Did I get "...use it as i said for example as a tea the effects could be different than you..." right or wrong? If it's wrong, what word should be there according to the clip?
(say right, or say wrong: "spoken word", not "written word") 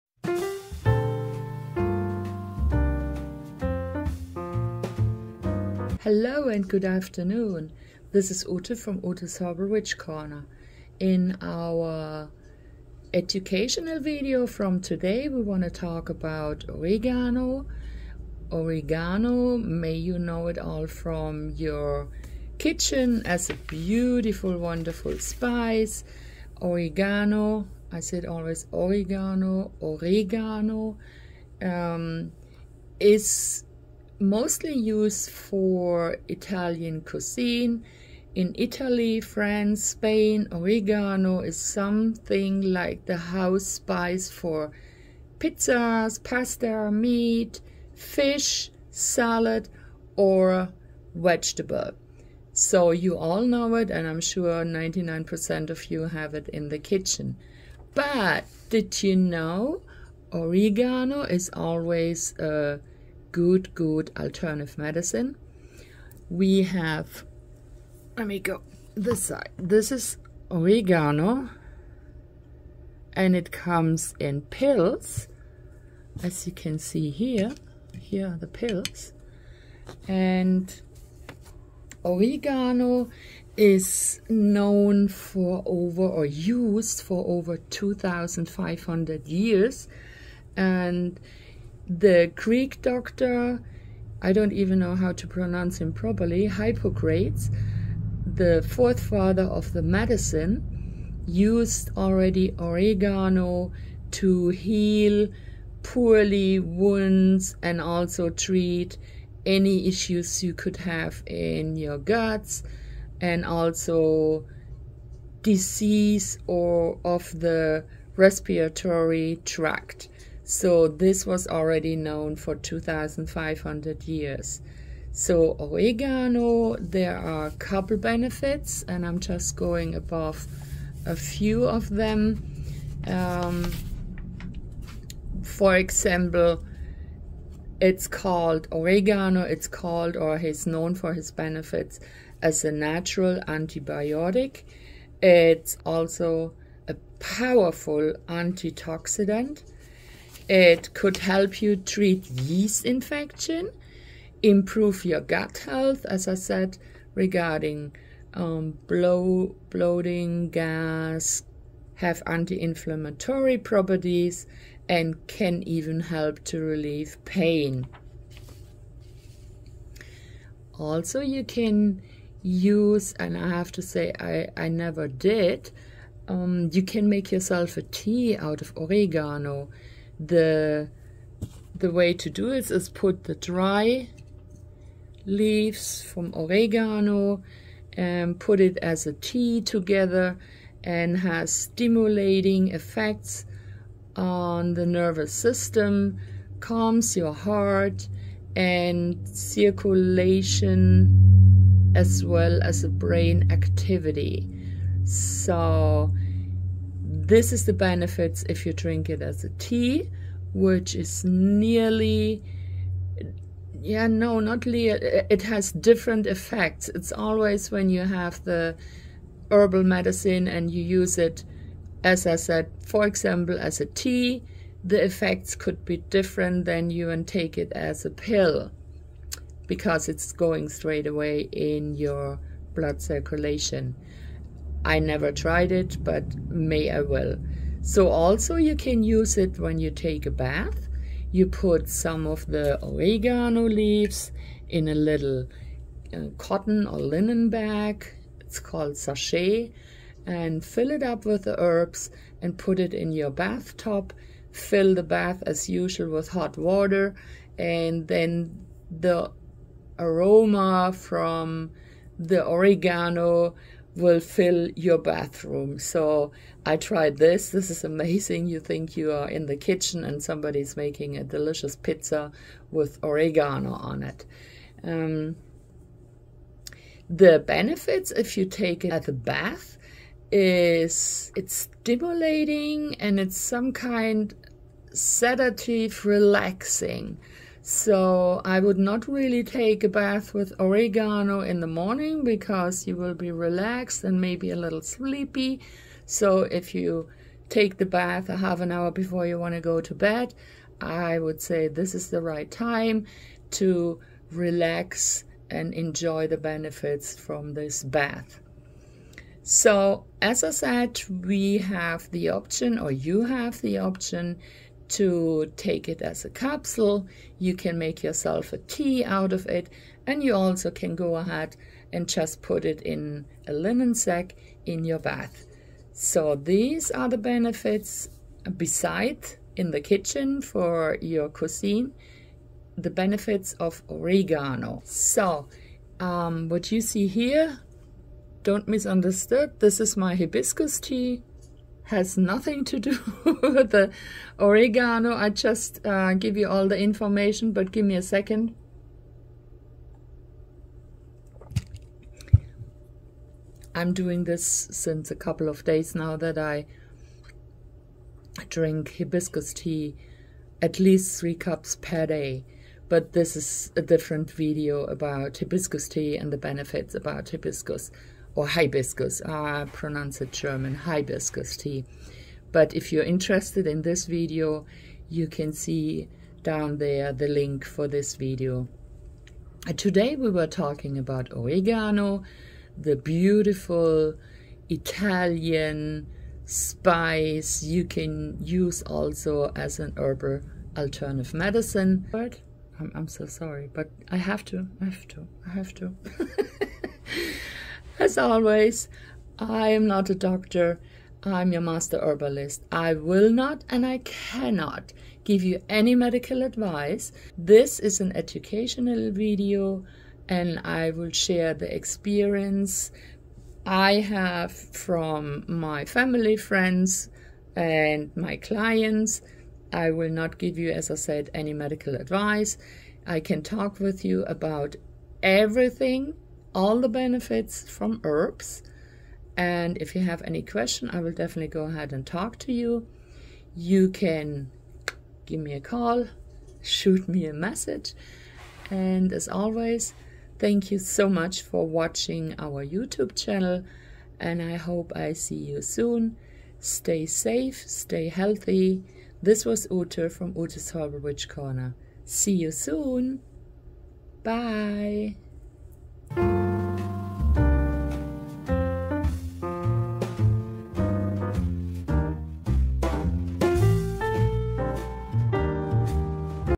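right.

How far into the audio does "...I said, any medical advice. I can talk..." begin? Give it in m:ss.
7:00.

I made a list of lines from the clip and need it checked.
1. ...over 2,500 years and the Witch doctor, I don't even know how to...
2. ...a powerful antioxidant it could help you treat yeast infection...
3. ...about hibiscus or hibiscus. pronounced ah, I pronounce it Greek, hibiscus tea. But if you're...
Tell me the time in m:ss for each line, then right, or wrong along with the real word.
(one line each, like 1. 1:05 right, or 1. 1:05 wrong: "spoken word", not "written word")
1. 1:27 wrong: "Greek", not "Witch"
2. 2:26 right
3. 6:06 wrong: "German", not "Greek".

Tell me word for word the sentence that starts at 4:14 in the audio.
Fill the bath as usual with hot water.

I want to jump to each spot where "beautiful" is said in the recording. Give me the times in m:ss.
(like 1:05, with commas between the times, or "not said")
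0:23, 6:22.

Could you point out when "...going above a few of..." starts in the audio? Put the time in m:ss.
2:09.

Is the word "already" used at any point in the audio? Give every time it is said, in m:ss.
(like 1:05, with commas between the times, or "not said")
1:41, 2:01.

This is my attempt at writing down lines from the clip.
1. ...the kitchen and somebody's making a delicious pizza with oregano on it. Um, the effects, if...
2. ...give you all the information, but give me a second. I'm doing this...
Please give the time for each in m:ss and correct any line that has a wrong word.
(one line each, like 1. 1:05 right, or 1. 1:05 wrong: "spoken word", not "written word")
1. 4:29 wrong: "benefits", not "effects"
2. 5:46 right.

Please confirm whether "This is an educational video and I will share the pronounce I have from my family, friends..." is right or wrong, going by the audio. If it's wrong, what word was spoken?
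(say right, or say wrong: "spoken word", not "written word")
wrong: "experience", not "pronounce".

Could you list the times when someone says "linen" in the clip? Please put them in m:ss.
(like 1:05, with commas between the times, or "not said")
4:06, 5:23.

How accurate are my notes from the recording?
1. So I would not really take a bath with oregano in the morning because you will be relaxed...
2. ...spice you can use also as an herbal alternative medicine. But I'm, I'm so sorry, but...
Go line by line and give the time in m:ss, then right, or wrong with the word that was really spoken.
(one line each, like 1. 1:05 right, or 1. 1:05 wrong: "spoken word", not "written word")
1. 4:47 right
2. 6:26 right.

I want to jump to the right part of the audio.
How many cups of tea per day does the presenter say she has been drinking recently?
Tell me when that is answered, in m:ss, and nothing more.
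6:01.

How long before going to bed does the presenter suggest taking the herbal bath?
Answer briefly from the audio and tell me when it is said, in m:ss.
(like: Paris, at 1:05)
Half an hour, at 4:58.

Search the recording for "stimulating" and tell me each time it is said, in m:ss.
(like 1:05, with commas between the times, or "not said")
3:11, 4:41.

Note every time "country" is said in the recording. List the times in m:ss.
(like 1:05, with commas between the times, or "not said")
not said.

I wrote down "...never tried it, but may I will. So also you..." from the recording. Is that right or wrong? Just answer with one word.
right.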